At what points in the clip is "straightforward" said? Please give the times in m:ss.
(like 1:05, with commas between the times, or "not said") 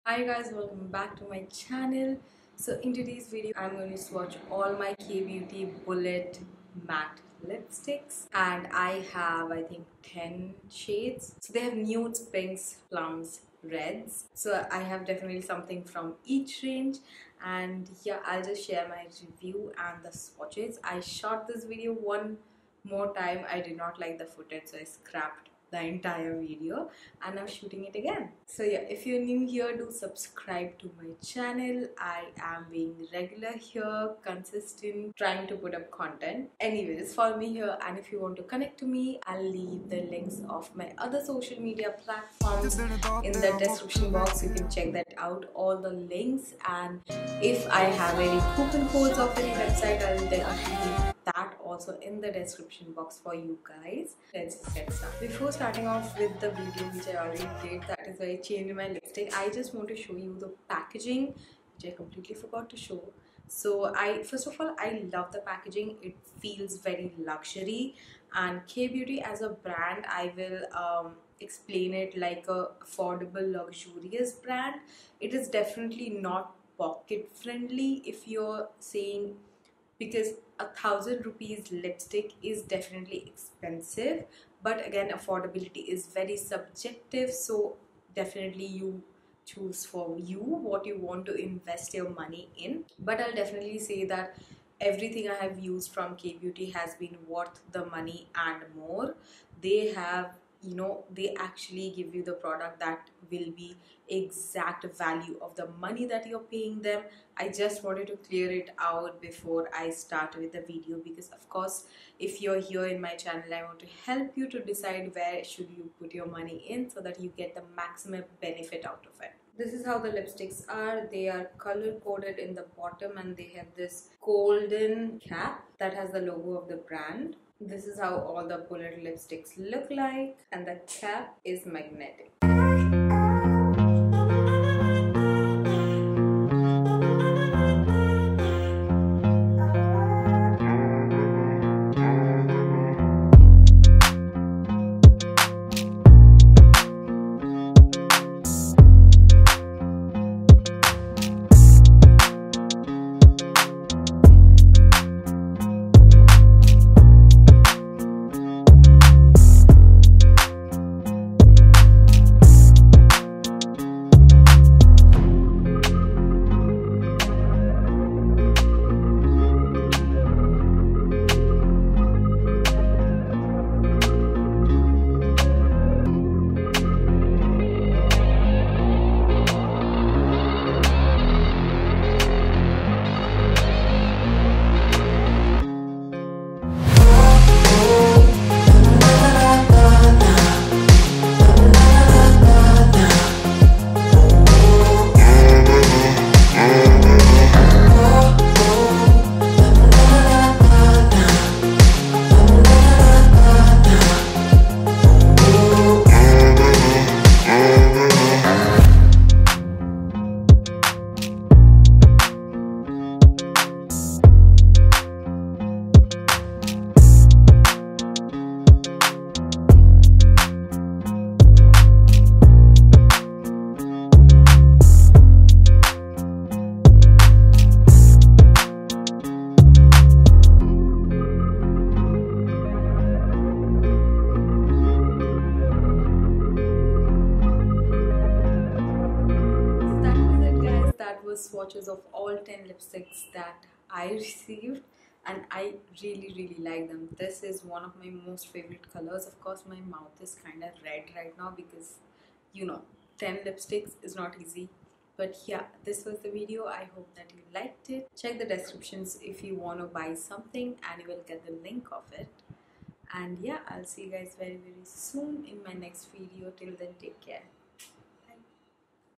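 not said.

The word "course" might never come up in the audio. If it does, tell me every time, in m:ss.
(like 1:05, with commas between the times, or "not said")
1:51, 4:09.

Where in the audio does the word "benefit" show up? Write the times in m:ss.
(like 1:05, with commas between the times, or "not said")
1:58.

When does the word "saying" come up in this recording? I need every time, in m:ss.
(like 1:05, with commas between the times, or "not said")
1:18.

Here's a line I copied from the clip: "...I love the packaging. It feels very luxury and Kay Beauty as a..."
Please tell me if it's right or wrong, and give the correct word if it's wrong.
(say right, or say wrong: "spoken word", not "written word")
right.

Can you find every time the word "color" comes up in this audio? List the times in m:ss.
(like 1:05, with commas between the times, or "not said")
2:01, 4:08.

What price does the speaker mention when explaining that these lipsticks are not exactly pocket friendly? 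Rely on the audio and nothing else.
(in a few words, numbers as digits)
1000 rupees.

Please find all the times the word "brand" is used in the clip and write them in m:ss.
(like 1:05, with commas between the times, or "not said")
1:09, 1:14, 2:06.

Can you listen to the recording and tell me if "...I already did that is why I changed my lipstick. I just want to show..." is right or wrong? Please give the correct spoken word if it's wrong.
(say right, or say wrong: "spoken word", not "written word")
right.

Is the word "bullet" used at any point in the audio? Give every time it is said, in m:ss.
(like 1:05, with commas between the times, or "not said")
0:05, 2:08.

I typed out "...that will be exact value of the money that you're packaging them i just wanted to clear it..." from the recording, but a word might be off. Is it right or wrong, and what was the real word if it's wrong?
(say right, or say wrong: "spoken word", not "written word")
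wrong: "paying", not "packaging".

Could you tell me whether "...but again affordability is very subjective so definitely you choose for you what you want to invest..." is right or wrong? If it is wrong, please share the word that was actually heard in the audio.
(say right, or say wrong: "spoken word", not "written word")
right.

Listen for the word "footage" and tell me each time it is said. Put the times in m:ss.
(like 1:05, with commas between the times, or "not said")
0:24.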